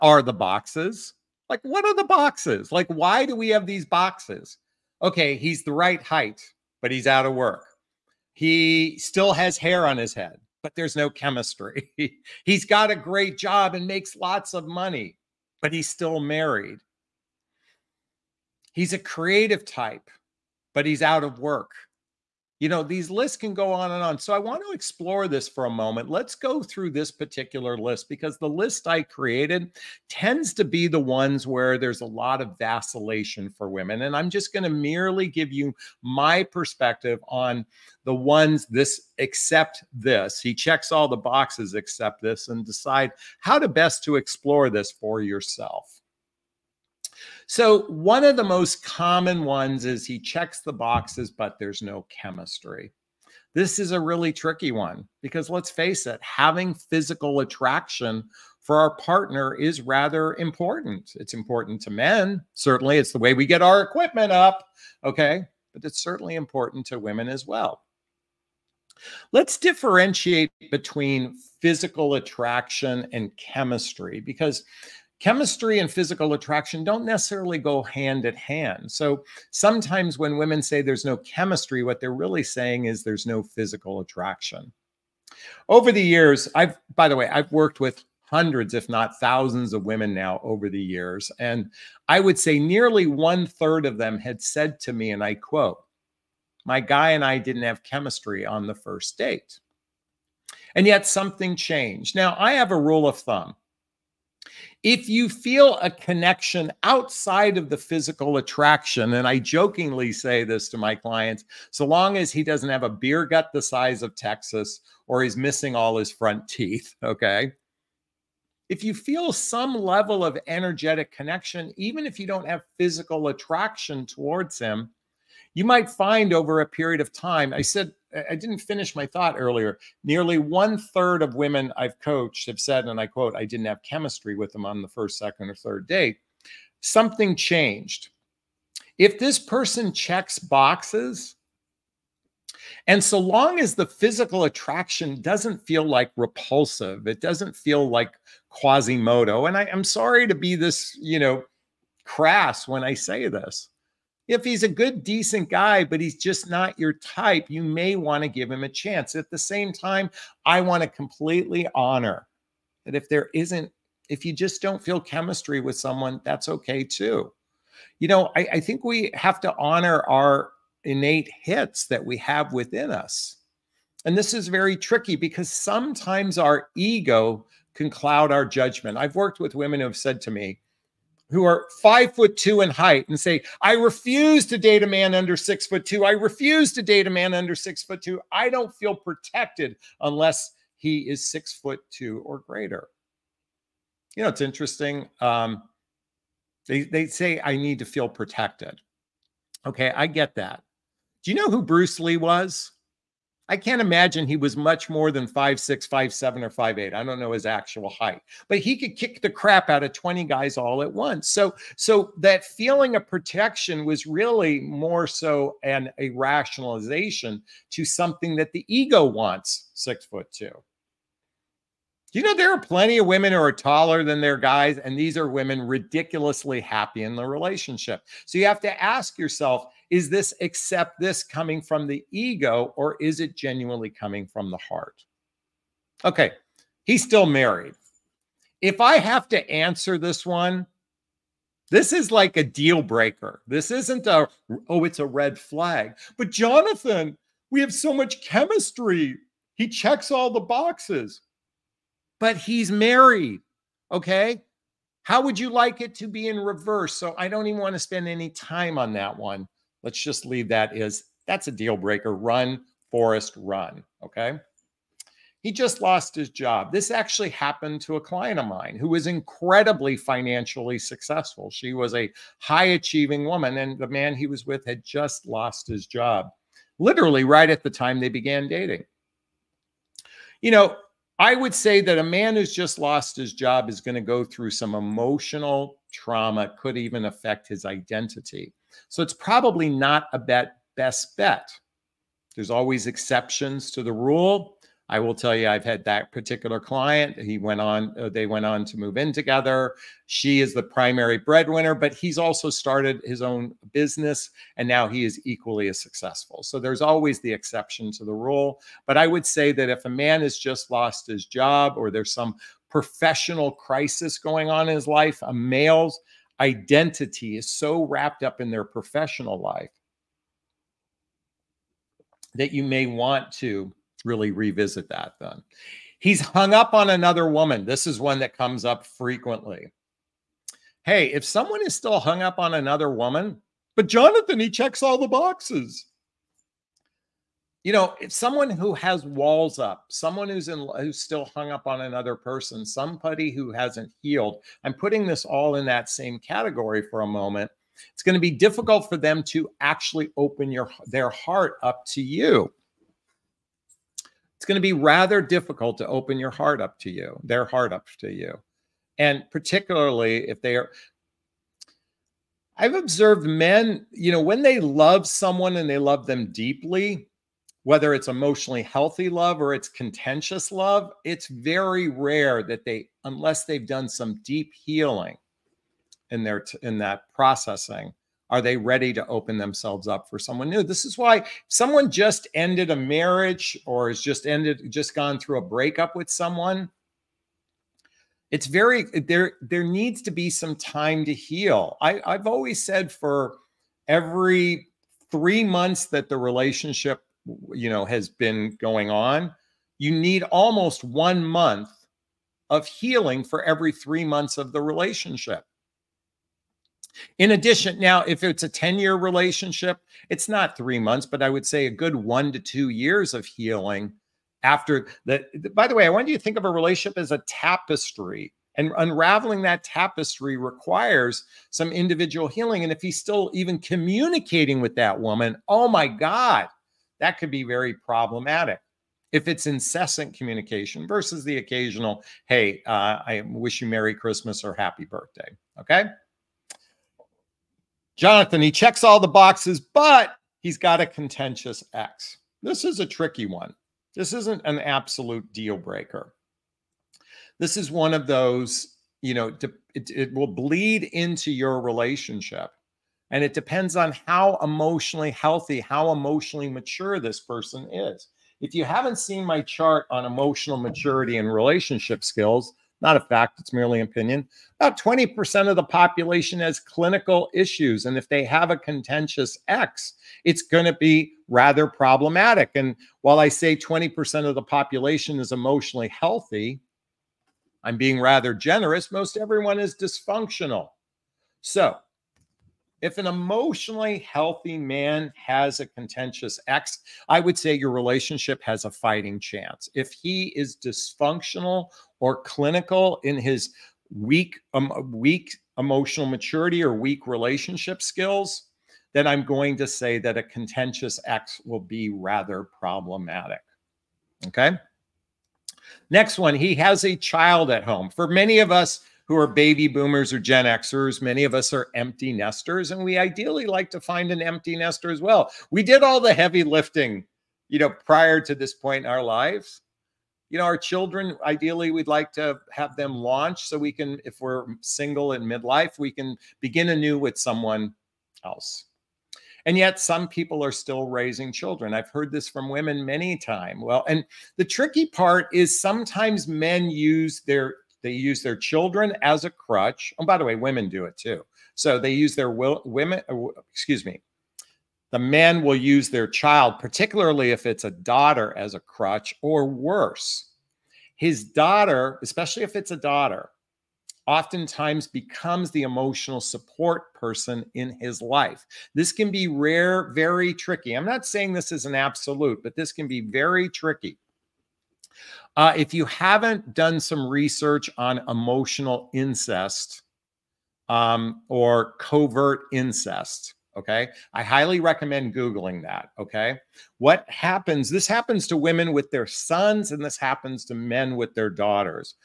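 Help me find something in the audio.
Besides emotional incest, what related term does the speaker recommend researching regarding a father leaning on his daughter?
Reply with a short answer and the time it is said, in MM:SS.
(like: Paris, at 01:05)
covert incest, at 09:31.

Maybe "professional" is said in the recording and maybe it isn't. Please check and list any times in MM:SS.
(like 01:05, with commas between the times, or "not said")
05:12, 05:18.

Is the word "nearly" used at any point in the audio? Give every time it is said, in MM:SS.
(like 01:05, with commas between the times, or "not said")
01:32, 02:10.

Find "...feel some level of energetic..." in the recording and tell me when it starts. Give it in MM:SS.
01:58.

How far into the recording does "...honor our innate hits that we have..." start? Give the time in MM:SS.
02:49.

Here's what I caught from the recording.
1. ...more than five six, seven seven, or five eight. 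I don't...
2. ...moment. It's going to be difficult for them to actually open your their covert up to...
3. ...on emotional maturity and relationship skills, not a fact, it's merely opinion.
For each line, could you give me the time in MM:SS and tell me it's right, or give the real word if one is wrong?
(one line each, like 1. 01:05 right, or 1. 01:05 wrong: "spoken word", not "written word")
1. 03:24 wrong: "five", not "seven"
2. 05:47 wrong: "heart", not "covert"
3. 07:39 right.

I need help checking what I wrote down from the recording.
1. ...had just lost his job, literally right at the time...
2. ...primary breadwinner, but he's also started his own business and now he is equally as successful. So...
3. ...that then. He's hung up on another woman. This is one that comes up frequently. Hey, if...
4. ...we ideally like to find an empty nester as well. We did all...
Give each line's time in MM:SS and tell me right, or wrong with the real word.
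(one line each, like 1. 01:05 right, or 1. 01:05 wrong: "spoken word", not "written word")
1. 04:34 right
2. 05:00 right
3. 05:24 right
4. 08:32 right.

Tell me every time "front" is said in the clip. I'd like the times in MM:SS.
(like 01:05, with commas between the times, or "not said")
01:56.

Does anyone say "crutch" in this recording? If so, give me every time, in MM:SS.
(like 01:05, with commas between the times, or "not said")
08:59, 09:08.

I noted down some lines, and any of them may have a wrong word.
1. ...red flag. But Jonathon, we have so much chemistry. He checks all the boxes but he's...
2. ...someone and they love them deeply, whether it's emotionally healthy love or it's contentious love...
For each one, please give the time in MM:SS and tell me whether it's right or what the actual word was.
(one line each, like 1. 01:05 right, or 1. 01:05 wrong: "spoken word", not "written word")
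1. 04:05 right
2. 06:05 right.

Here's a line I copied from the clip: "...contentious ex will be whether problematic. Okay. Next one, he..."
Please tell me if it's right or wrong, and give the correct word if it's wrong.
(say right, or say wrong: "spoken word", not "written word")
wrong: "rather", not "whether".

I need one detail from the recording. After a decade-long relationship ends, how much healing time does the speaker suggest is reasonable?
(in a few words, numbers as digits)
1 to 2 years.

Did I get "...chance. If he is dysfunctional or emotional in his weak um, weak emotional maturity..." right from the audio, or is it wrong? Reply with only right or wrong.
wrong.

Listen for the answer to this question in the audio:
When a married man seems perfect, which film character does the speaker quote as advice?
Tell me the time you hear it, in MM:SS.
04:22.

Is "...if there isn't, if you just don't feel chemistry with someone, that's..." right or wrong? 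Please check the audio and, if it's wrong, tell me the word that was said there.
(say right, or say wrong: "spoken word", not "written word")
right.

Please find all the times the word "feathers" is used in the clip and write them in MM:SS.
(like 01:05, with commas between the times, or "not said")
not said.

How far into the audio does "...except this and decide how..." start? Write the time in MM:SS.
00:41.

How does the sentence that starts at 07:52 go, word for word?
And while I say 20% of the population is emotionally healthy, I'm being rather generous.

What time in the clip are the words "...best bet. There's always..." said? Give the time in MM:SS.
04:50.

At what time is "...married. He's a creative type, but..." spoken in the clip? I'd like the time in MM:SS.
00:16.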